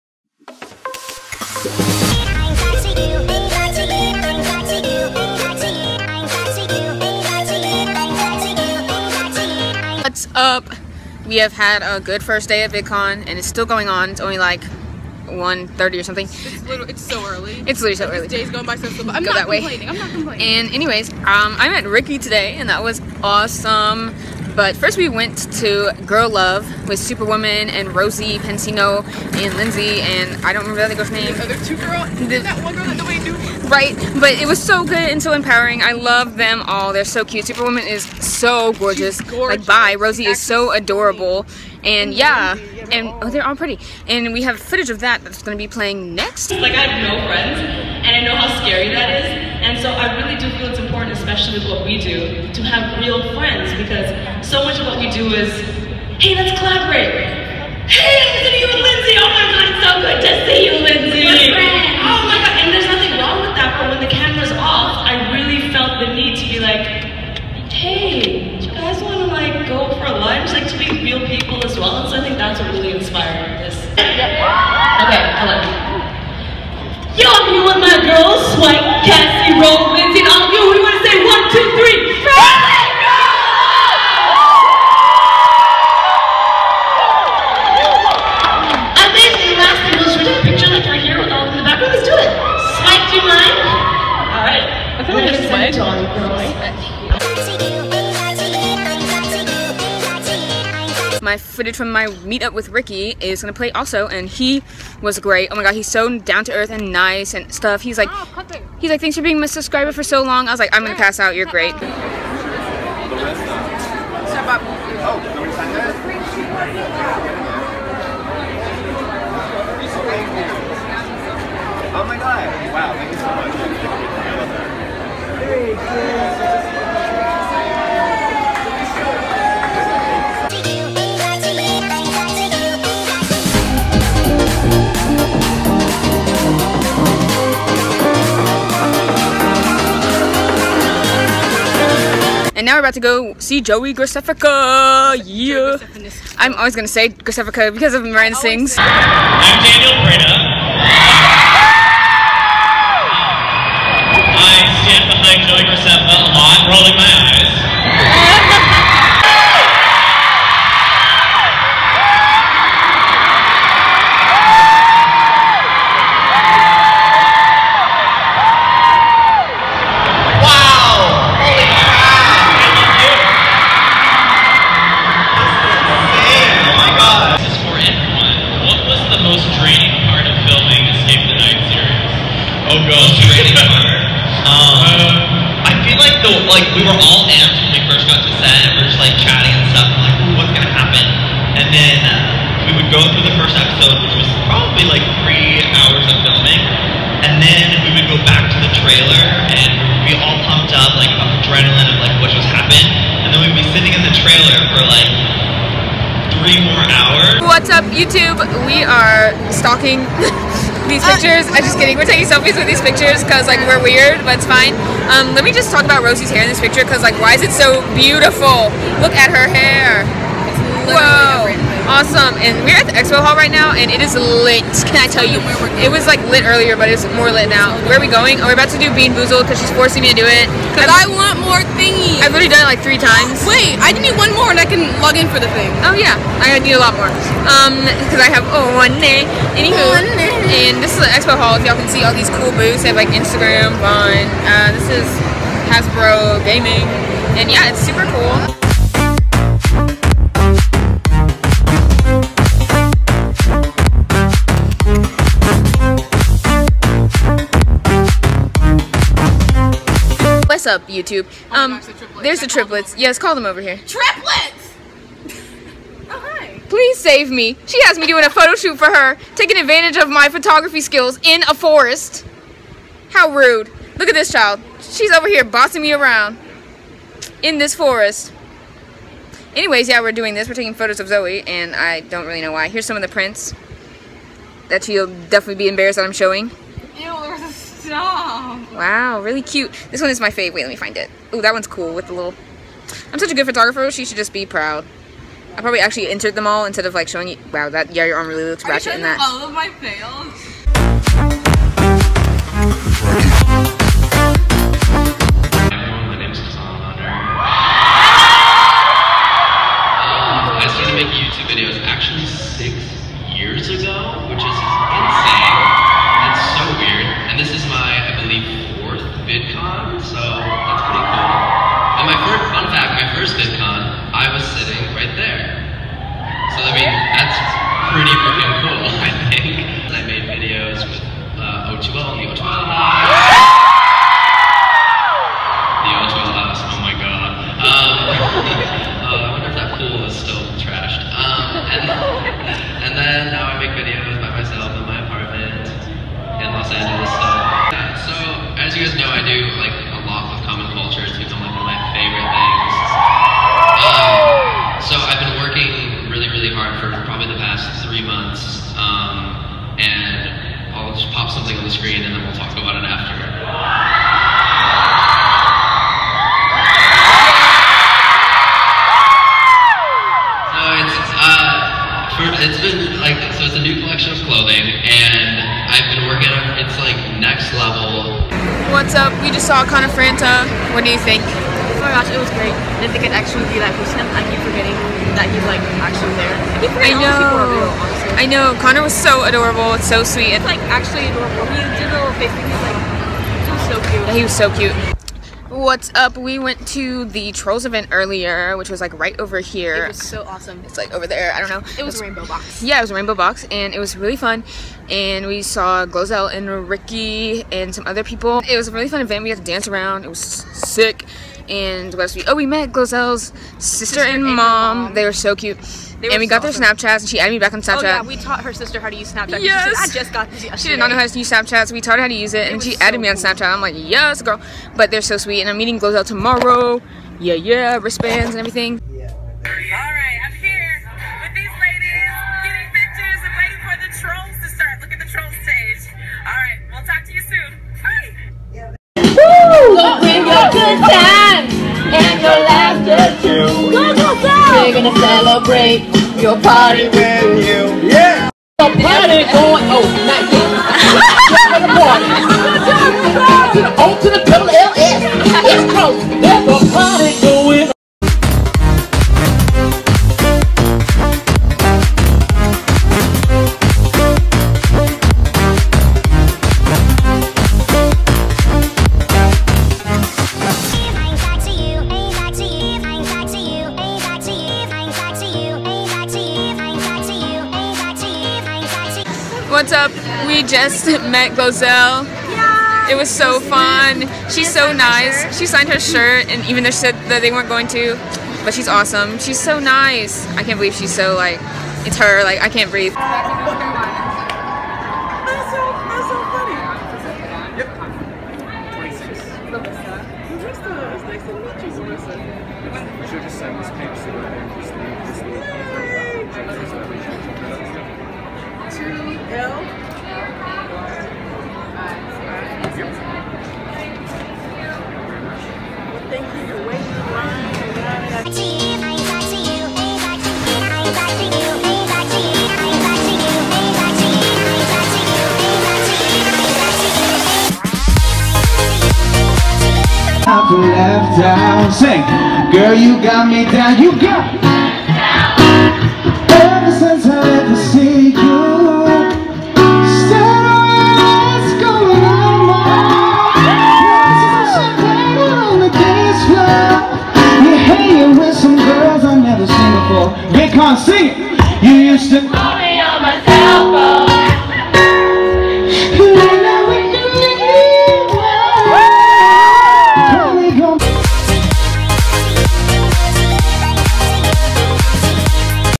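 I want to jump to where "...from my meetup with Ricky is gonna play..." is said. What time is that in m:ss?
1:41.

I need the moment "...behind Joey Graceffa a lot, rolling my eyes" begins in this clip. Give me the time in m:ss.
2:35.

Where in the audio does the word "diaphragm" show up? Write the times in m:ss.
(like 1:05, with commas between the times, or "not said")
not said.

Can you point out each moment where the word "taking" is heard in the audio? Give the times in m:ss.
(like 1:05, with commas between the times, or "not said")
3:32, 4:29, 4:40.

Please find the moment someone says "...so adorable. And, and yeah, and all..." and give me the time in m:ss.
0:40.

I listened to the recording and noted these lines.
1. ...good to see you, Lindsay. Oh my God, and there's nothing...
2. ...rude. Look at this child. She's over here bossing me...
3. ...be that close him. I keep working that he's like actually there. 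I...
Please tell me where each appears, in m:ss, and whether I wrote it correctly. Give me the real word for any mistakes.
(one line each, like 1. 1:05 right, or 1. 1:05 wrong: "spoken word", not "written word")
1. 1:00 right
2. 4:33 right
3. 6:23 wrong: "forgetting", not "working".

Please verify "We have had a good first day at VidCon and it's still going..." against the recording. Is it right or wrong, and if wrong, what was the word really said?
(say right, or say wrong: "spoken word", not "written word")
right.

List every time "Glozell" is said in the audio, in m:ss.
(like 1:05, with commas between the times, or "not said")
6:45, 6:52, 7:05, 8:01.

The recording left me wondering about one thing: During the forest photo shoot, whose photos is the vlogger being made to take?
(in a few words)
Zoe.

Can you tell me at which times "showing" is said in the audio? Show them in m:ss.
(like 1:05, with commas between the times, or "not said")
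4:46, 4:57.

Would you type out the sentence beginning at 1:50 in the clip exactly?
I was like, I'm gonna pass out.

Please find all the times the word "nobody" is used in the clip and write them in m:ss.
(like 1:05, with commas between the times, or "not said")
0:32.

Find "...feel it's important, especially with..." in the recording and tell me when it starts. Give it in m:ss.
0:50.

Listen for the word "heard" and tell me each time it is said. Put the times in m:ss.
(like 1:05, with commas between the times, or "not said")
not said.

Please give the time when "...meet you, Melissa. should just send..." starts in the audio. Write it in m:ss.
8:21.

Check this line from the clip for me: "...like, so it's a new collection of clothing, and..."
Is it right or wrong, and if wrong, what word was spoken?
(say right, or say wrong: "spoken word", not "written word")
right.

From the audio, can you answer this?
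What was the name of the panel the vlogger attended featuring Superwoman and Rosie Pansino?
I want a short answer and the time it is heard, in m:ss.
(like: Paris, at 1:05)
Girl Love, at 0:26.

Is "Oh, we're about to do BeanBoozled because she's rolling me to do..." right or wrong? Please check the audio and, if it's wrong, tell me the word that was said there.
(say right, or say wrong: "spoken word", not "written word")
wrong: "forcing", not "rolling".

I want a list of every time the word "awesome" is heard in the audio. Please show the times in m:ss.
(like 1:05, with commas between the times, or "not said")
0:23, 3:41, 6:40, 6:56, 8:08.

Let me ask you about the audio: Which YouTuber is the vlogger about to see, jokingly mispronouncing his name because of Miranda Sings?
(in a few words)
Joey Graceffa.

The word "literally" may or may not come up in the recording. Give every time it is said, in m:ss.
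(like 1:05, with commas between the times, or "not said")
0:17, 3:40.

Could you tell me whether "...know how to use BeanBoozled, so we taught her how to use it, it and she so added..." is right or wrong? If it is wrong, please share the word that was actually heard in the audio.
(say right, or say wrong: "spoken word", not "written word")
wrong: "Snapchat", not "BeanBoozled".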